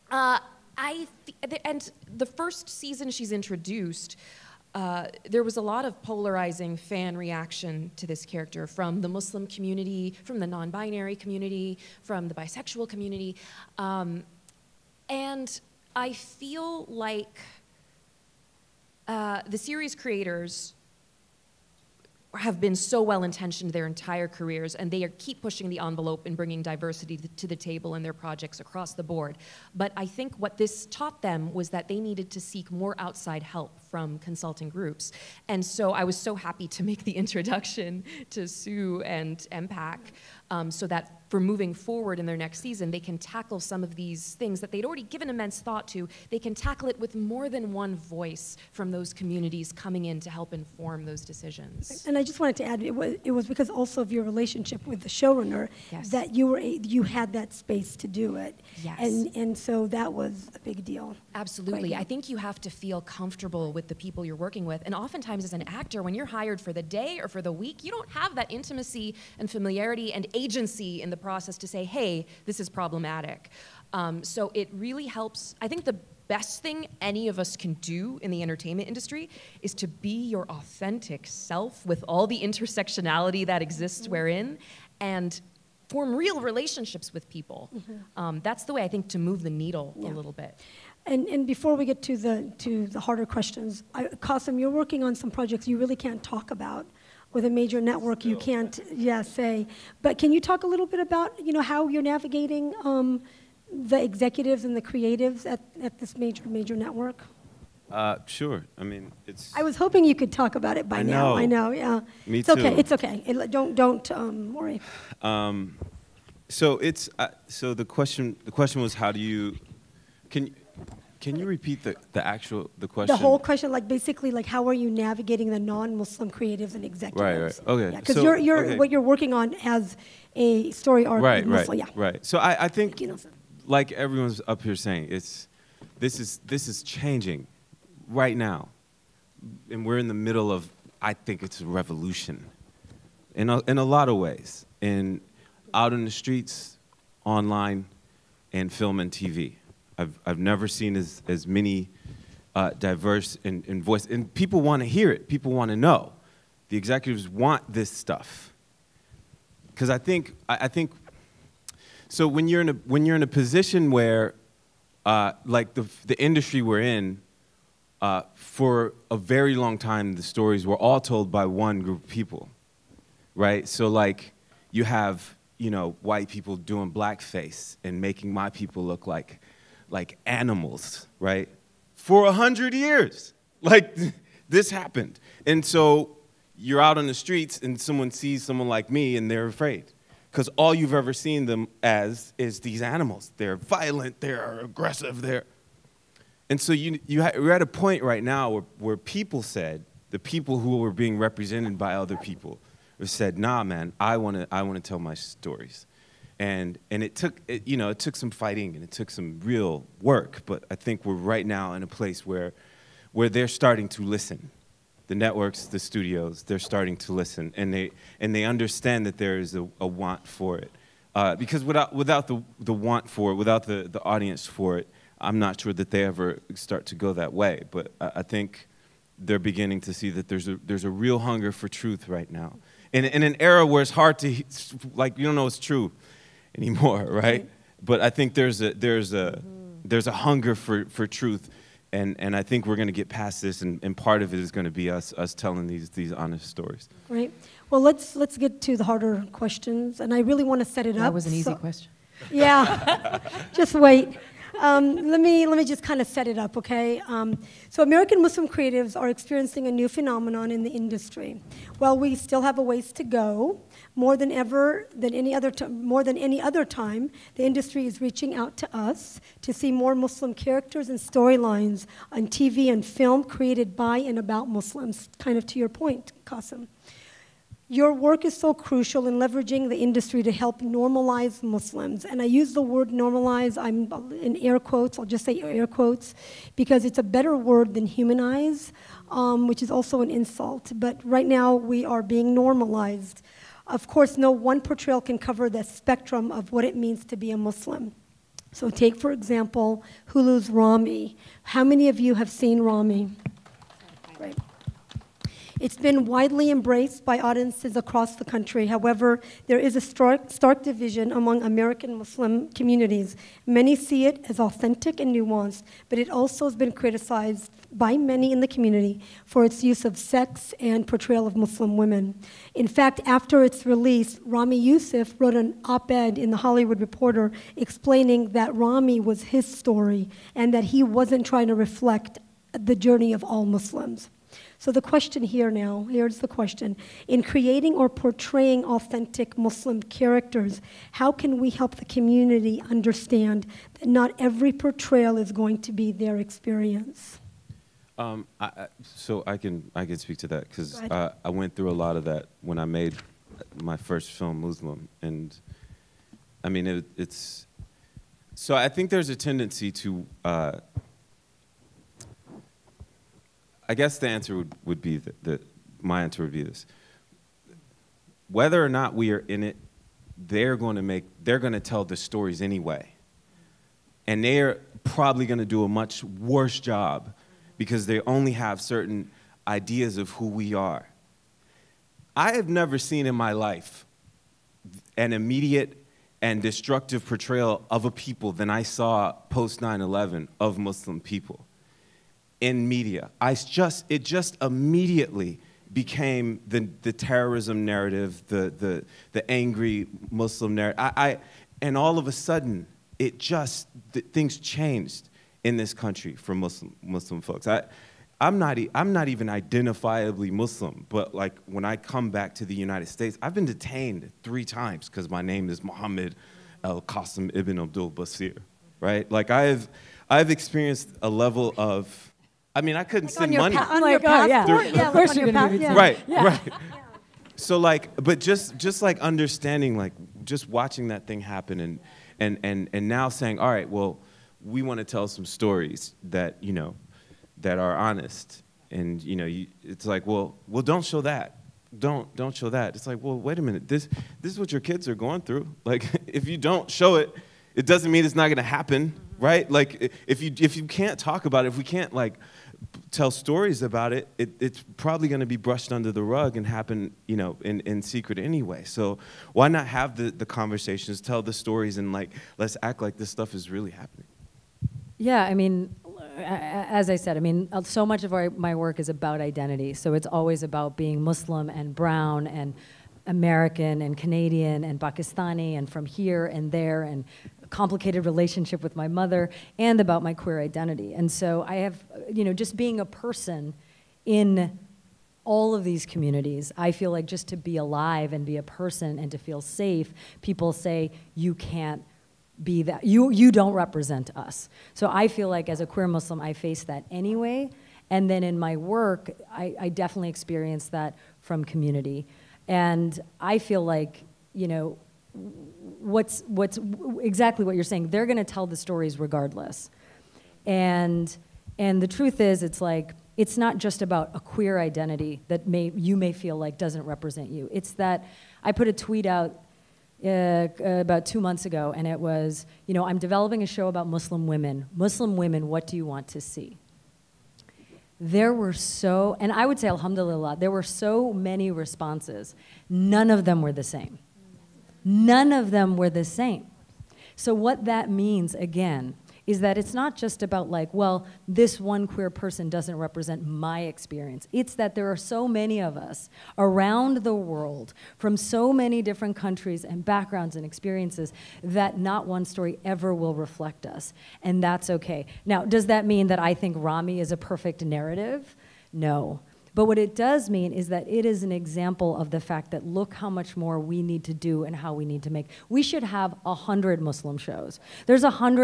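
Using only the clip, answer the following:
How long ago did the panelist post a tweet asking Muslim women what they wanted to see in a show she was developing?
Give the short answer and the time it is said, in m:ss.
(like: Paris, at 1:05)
about two months ago, at 8:40.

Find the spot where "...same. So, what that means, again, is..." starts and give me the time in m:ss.
8:56.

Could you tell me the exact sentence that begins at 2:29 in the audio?
I've, I've never seen as, as many uh, diverse in, in voice.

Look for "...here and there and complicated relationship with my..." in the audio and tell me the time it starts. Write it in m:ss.
7:55.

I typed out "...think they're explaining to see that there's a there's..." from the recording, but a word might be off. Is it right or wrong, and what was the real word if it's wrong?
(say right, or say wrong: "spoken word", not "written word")
wrong: "beginning", not "explaining".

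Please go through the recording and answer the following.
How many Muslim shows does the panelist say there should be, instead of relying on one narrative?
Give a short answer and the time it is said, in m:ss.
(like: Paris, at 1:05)
100, at 9:26.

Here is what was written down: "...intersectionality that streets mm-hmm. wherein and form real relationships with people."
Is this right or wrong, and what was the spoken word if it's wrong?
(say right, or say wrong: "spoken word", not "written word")
wrong: "exists", not "streets".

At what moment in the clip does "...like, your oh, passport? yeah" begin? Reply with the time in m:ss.
7:03.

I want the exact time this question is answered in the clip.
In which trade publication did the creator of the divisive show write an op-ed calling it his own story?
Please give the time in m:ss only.
5:26.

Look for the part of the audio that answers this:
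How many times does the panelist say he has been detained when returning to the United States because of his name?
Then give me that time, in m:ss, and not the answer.
6:54.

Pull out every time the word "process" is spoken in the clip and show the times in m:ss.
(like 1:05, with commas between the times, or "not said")
1:11.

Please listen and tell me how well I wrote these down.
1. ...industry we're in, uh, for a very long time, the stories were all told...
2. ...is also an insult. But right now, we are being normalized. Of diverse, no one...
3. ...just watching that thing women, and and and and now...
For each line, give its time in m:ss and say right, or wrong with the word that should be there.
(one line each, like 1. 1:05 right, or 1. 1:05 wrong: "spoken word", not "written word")
1. 2:46 right
2. 4:49 wrong: "course", not "diverse"
3. 7:10 wrong: "happen", not "women".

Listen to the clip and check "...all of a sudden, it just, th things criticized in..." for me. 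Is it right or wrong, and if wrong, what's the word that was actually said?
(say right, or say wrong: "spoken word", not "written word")
wrong: "changed", not "criticized".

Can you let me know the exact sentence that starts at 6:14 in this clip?
And they're probably going to do a much worse job because they only have certain ideas of who we are.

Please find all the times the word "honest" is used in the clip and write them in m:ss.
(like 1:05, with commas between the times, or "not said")
4:06, 7:17.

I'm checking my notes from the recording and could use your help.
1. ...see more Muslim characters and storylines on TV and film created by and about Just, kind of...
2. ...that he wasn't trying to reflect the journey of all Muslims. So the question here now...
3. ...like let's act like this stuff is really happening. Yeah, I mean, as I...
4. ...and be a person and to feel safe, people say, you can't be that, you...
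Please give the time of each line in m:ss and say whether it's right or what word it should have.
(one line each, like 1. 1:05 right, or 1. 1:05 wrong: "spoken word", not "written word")
1. 4:29 wrong: "Muslims", not "Just"
2. 5:30 right
3. 7:41 right
4. 8:08 right.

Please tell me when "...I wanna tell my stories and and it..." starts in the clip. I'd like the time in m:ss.
3:24.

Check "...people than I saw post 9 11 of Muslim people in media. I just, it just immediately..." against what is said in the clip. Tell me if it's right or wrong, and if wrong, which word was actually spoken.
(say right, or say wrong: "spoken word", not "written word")
right.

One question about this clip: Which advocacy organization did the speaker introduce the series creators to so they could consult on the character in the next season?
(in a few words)
MPAC.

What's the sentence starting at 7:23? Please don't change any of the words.
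This this is what your kids are going through.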